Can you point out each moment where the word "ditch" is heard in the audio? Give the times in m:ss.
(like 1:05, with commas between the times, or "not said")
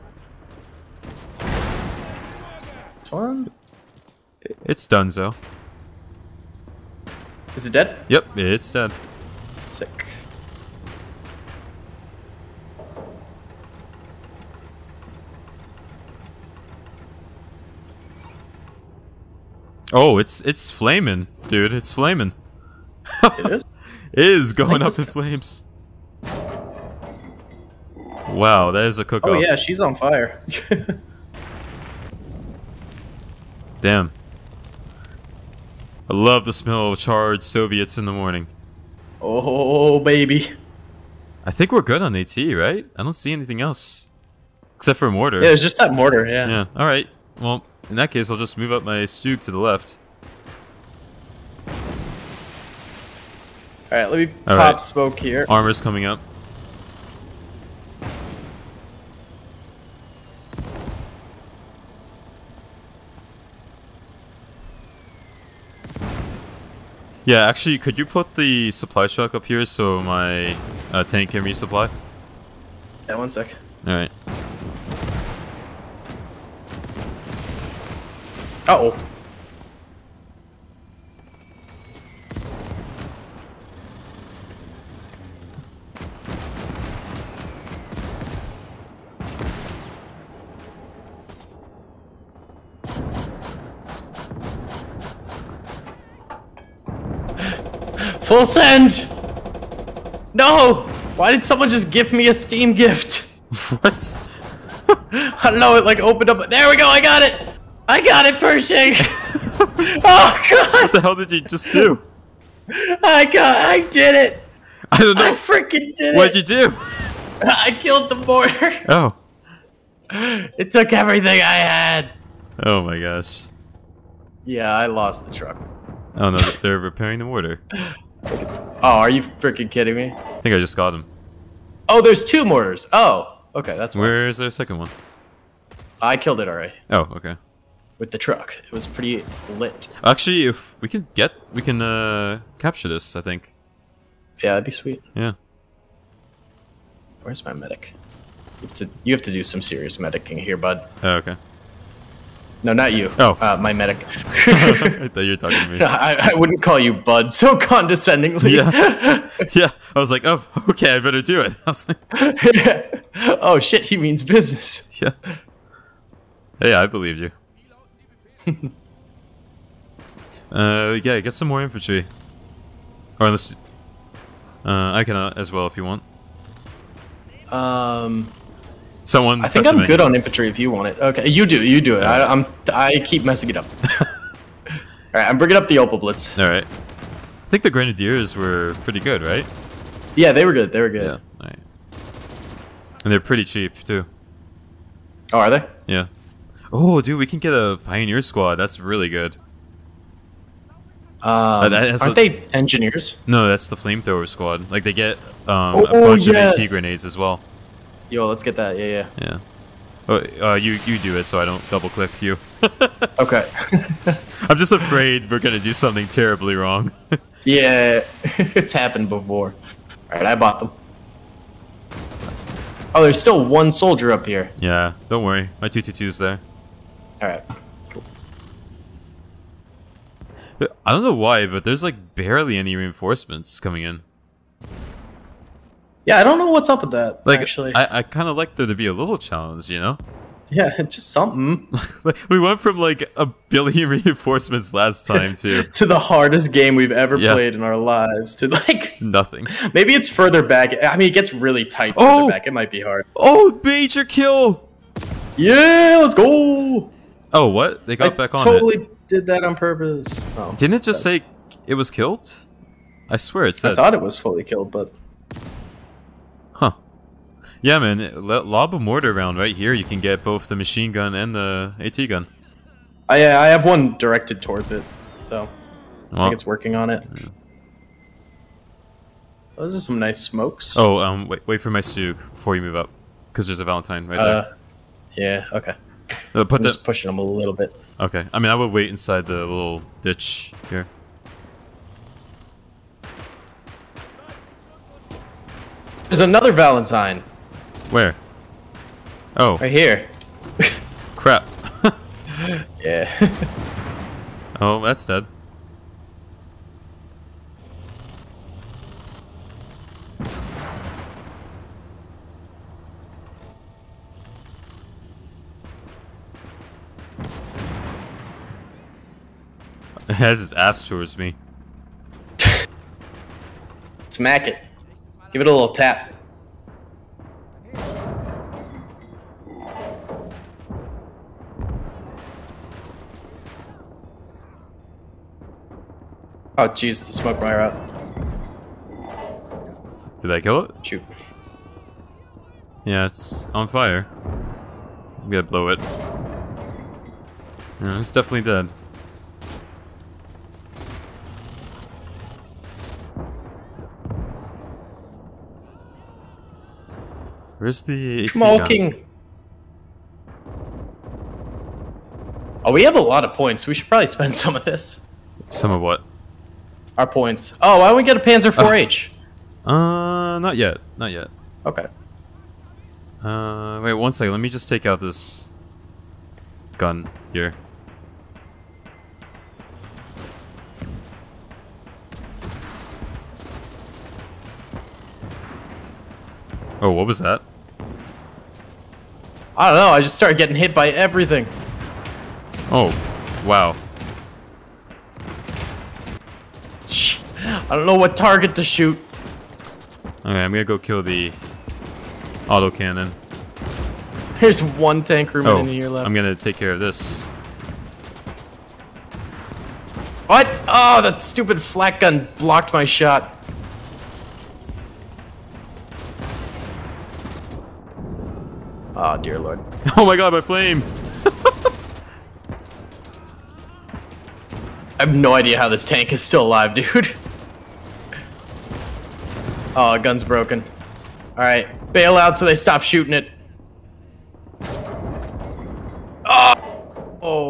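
4:50.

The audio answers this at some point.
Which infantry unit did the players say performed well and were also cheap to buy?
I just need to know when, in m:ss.
3:07.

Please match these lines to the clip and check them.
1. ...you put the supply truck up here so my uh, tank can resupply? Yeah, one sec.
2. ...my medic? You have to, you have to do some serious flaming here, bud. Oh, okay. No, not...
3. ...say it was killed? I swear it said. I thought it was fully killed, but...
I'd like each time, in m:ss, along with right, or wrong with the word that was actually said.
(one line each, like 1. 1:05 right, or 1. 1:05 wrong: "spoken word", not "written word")
1. 1:07 right
2. 2:27 wrong: "medicing", not "flaming"
3. 4:21 right.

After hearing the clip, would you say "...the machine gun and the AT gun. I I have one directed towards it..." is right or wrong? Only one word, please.
right.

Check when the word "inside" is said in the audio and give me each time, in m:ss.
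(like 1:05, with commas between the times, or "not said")
4:48.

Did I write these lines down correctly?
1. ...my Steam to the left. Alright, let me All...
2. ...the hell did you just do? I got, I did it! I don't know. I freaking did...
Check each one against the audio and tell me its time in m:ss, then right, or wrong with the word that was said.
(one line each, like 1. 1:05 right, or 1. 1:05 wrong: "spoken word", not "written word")
1. 0:48 wrong: "Stug", not "Steam"
2. 1:50 right.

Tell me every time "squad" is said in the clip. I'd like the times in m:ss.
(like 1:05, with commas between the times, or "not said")
3:18, 3:24.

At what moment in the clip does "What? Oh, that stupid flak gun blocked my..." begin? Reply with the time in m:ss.
6:50.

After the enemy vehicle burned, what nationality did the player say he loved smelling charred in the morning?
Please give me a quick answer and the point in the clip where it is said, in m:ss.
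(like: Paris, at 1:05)
Soviets, at 0:37.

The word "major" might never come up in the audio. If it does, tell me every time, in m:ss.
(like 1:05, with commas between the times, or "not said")
4:13.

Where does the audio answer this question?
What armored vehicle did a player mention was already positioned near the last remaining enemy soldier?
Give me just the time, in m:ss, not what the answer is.
3:45.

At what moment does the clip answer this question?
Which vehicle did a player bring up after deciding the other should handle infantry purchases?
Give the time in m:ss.
3:05.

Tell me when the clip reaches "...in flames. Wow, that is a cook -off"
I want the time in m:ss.
0:24.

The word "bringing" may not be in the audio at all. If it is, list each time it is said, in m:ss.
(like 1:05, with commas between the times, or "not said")
3:05.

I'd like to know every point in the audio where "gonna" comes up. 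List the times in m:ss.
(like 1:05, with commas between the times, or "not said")
3:35, 5:45, 6:40, 6:46.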